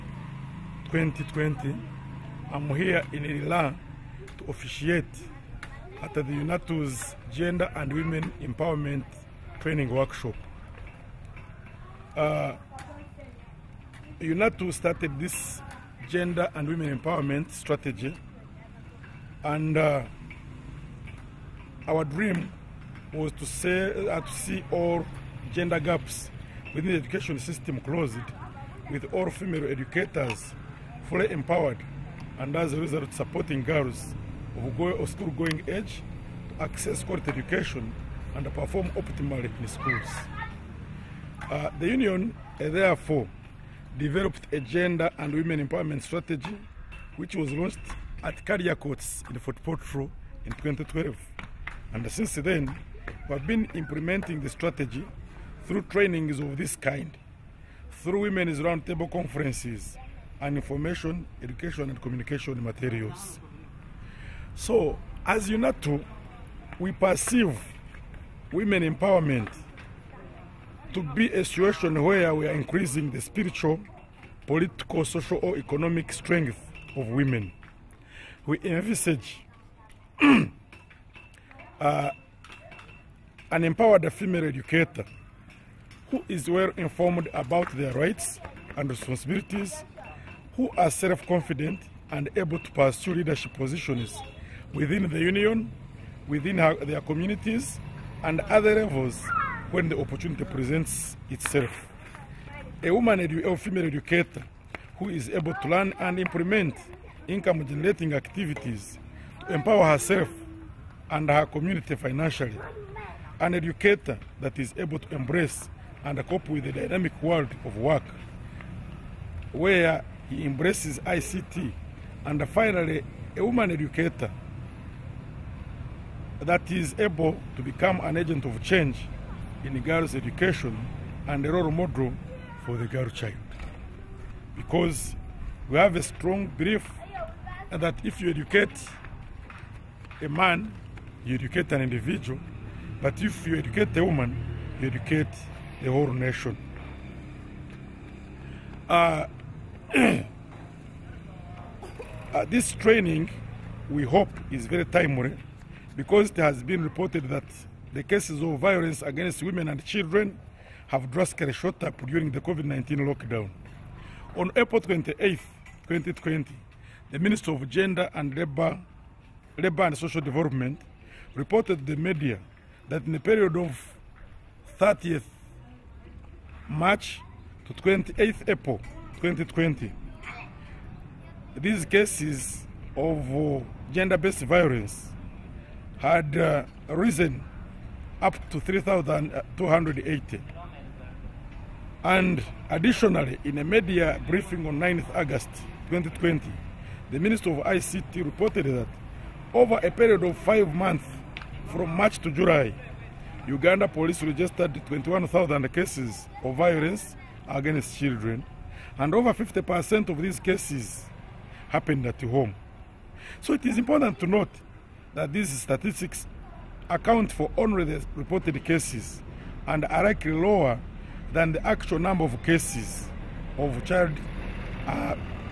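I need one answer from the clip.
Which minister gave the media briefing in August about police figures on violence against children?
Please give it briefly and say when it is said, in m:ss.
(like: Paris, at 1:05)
Minister of ICT, at 3:17.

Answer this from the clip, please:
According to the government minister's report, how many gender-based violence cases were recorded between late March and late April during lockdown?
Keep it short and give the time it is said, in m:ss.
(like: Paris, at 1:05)
3,280, at 3:08.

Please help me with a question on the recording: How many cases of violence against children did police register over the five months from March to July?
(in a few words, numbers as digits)
21,000.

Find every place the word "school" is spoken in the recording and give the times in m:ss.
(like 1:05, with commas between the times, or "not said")
0:35, 0:39.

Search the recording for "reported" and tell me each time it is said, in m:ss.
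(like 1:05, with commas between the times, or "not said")
2:36, 2:51, 3:18, 3:38.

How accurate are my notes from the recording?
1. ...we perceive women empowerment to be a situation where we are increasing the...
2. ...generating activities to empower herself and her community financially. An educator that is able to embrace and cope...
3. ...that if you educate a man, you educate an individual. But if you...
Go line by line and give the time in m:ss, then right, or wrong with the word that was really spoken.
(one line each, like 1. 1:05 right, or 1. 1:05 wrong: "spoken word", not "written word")
1. 1:06 right
2. 1:47 right
3. 2:17 right.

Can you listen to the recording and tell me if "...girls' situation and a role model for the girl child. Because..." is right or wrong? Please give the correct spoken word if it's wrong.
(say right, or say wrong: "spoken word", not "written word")
wrong: "education", not "situation".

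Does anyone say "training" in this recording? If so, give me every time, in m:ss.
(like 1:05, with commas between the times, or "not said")
0:09, 0:55, 2:32.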